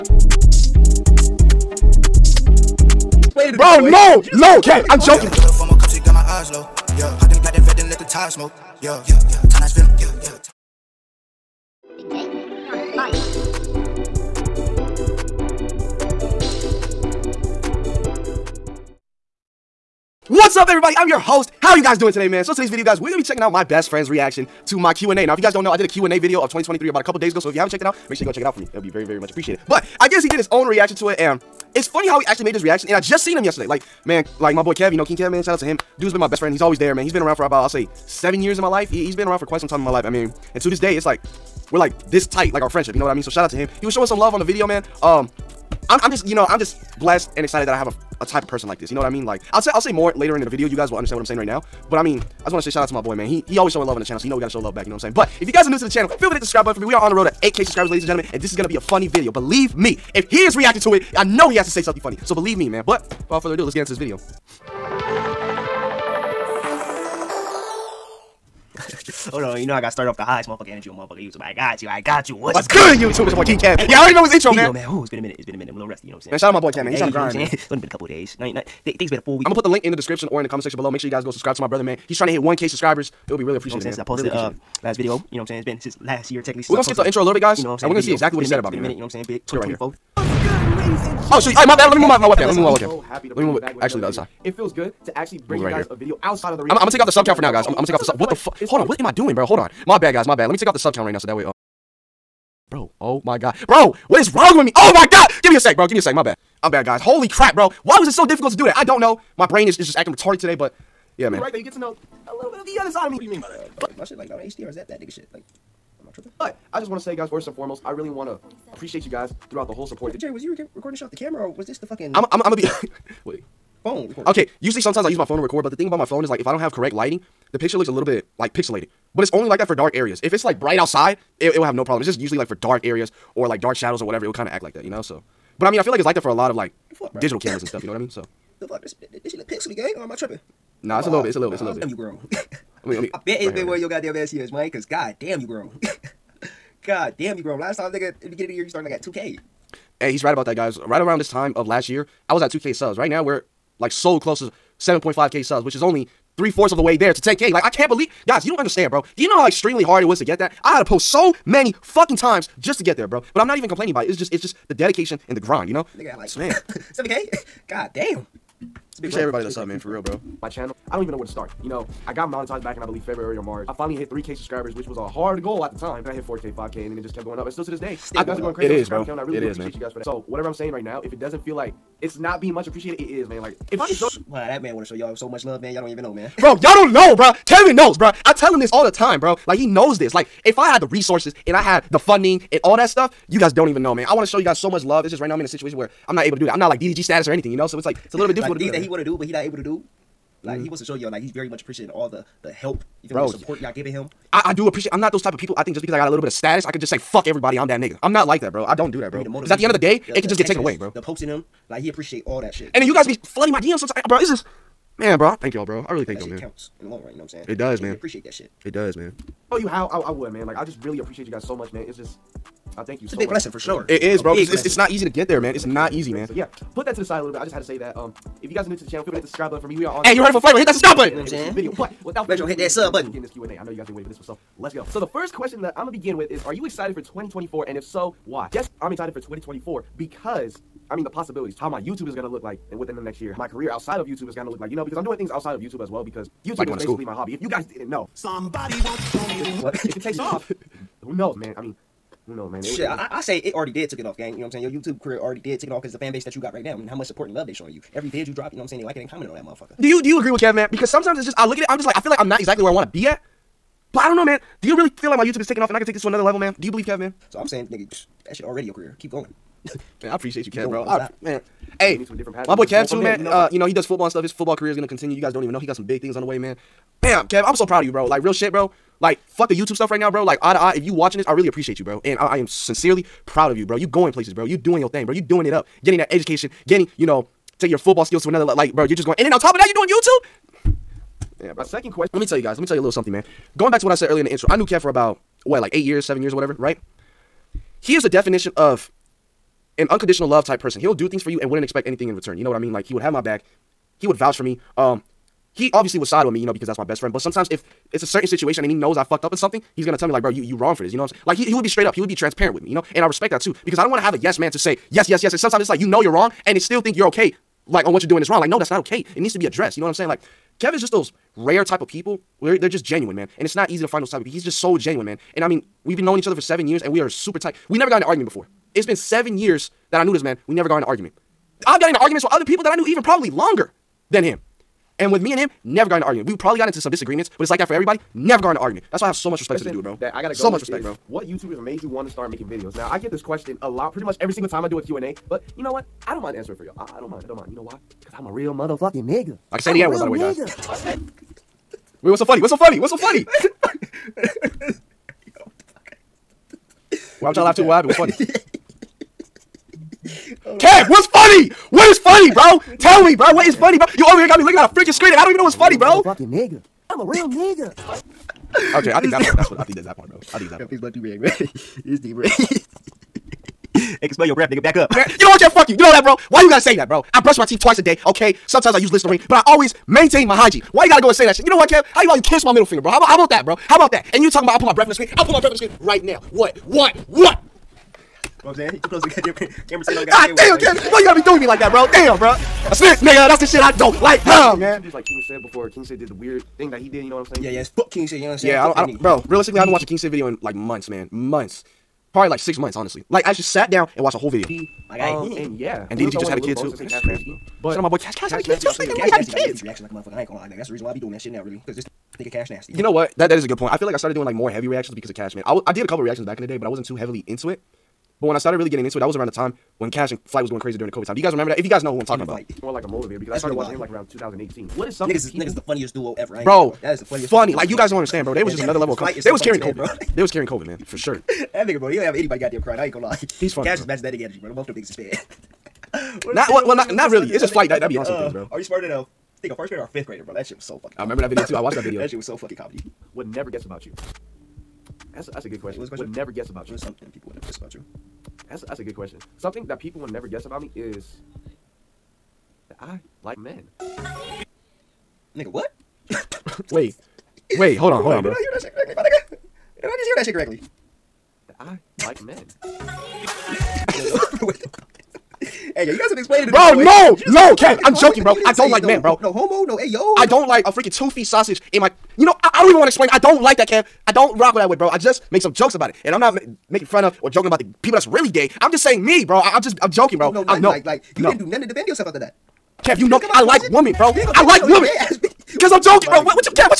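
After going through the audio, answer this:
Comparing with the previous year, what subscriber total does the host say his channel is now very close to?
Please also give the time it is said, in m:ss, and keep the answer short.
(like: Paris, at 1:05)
7.5K, at 2:34.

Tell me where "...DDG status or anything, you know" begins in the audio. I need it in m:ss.
3:16.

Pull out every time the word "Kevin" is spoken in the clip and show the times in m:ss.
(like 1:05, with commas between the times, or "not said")
3:07, 5:20.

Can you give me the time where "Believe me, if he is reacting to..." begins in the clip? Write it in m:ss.
0:59.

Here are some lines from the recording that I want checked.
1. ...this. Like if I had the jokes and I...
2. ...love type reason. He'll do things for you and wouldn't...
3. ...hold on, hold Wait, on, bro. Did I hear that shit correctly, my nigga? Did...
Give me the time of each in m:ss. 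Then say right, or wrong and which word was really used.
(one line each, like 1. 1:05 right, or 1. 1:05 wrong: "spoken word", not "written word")
1. 3:09 wrong: "resources", not "jokes"
2. 5:00 wrong: "person", not "reason"
3. 7:37 right.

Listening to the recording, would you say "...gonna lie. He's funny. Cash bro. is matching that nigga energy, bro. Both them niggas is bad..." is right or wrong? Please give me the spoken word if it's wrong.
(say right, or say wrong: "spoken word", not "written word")
right.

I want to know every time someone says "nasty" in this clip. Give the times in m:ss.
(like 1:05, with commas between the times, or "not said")
6:48, 6:52.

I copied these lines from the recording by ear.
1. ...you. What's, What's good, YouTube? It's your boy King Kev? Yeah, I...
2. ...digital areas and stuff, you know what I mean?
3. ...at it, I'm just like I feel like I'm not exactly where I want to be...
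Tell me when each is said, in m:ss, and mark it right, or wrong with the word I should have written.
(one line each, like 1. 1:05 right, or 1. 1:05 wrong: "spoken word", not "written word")
1. 1:12 right
2. 2:17 wrong: "cameras", not "areas"
3. 4:21 right.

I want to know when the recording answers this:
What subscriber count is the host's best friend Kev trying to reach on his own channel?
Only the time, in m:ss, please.
1:22.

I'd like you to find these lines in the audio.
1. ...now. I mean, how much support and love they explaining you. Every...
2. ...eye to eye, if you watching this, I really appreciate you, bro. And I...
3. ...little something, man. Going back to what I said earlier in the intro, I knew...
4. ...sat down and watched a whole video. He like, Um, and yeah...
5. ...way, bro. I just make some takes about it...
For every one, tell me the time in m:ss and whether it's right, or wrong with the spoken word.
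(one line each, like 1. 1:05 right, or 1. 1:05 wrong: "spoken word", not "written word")
1. 4:16 wrong: "showing", not "explaining"
2. 4:40 right
3. 4:52 right
4. 6:43 right
5. 7:54 wrong: "jokes", not "takes".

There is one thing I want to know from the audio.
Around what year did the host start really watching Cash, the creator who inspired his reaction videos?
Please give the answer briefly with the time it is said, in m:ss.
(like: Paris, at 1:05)
2018, at 7:04.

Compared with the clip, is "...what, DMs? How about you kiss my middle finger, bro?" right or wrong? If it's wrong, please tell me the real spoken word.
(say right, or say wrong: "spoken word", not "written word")
wrong: "Kev", not "DMs".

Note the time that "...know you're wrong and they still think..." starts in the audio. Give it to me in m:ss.
5:15.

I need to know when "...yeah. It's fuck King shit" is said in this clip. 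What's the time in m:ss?
6:37.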